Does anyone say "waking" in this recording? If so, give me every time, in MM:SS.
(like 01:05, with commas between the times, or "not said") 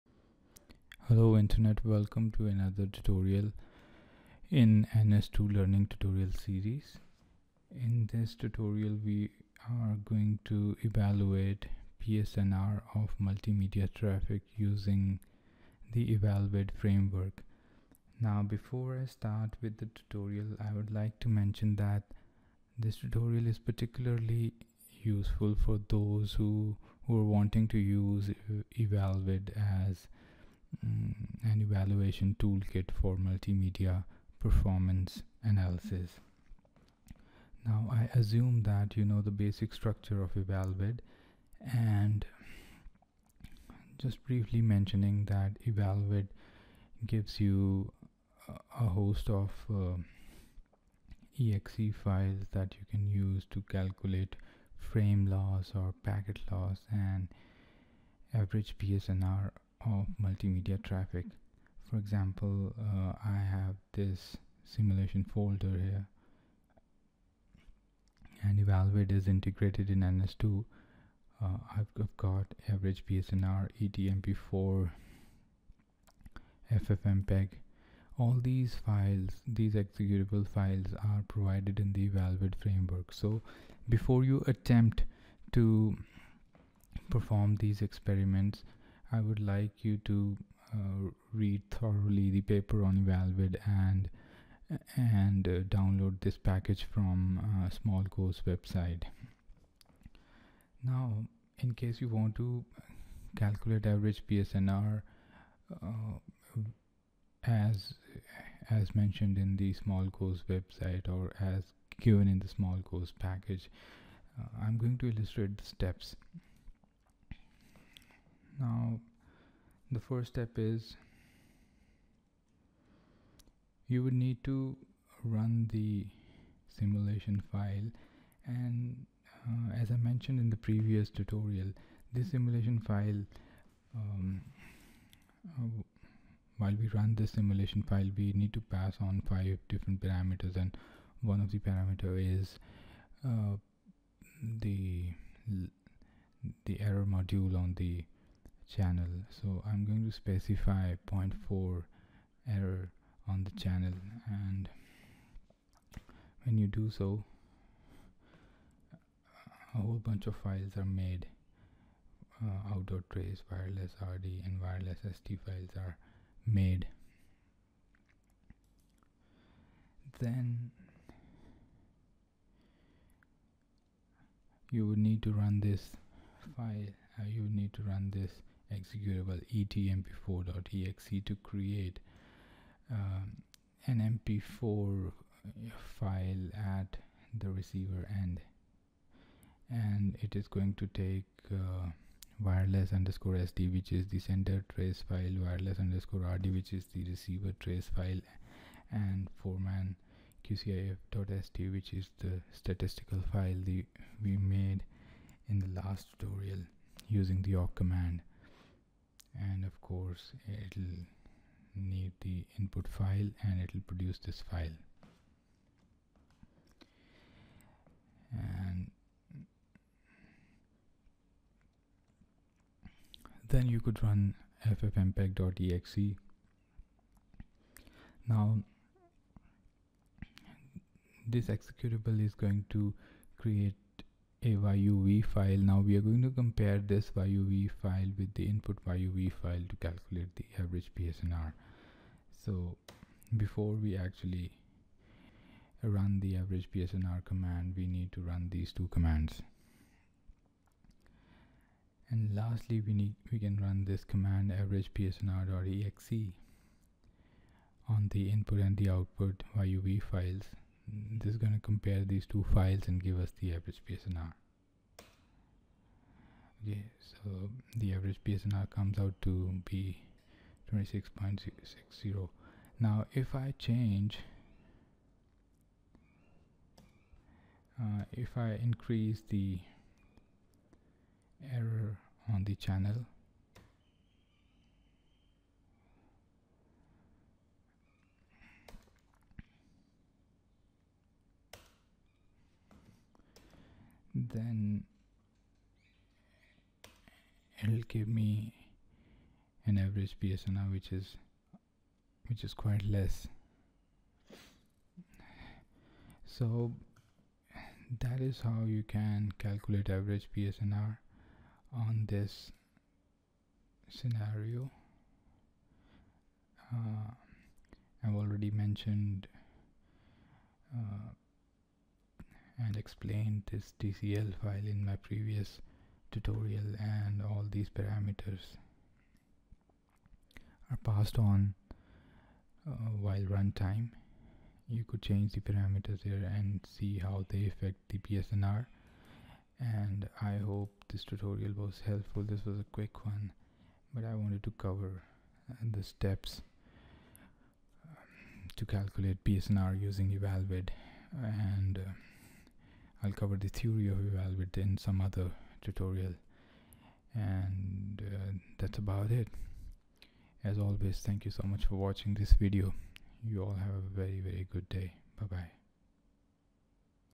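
not said.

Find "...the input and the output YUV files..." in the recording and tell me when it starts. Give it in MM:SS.
04:18.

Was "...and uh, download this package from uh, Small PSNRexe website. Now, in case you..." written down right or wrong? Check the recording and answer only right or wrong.
wrong.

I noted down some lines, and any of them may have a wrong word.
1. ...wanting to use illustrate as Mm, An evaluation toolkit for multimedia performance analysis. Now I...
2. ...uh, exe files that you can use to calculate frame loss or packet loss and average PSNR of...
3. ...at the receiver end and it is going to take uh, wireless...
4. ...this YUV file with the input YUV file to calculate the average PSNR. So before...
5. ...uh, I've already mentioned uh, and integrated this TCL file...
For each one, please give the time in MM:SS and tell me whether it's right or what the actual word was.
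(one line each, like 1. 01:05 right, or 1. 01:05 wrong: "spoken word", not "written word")
1. 00:27 wrong: "evaluate", not "illustrate"
2. 00:49 right
3. 03:06 right
4. 03:56 right
5. 05:16 wrong: "explained", not "integrated".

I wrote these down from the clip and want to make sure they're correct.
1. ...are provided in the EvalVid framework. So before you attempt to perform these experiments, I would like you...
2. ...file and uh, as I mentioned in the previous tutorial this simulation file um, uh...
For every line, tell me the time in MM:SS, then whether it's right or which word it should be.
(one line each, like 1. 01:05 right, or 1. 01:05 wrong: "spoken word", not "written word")
1. 01:21 right
2. 02:07 right.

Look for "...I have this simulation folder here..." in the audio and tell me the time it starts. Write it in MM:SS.
01:03.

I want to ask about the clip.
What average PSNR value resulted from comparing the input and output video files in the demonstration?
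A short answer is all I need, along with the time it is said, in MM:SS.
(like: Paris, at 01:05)
26.60, at 04:30.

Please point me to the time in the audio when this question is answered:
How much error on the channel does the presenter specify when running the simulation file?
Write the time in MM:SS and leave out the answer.
02:31.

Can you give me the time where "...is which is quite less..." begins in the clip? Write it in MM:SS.
05:00.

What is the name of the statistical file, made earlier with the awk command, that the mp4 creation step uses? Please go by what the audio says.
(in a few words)
foreman qcif.st.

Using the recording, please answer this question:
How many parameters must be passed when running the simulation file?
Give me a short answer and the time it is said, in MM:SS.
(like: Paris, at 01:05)
5, at 02:19.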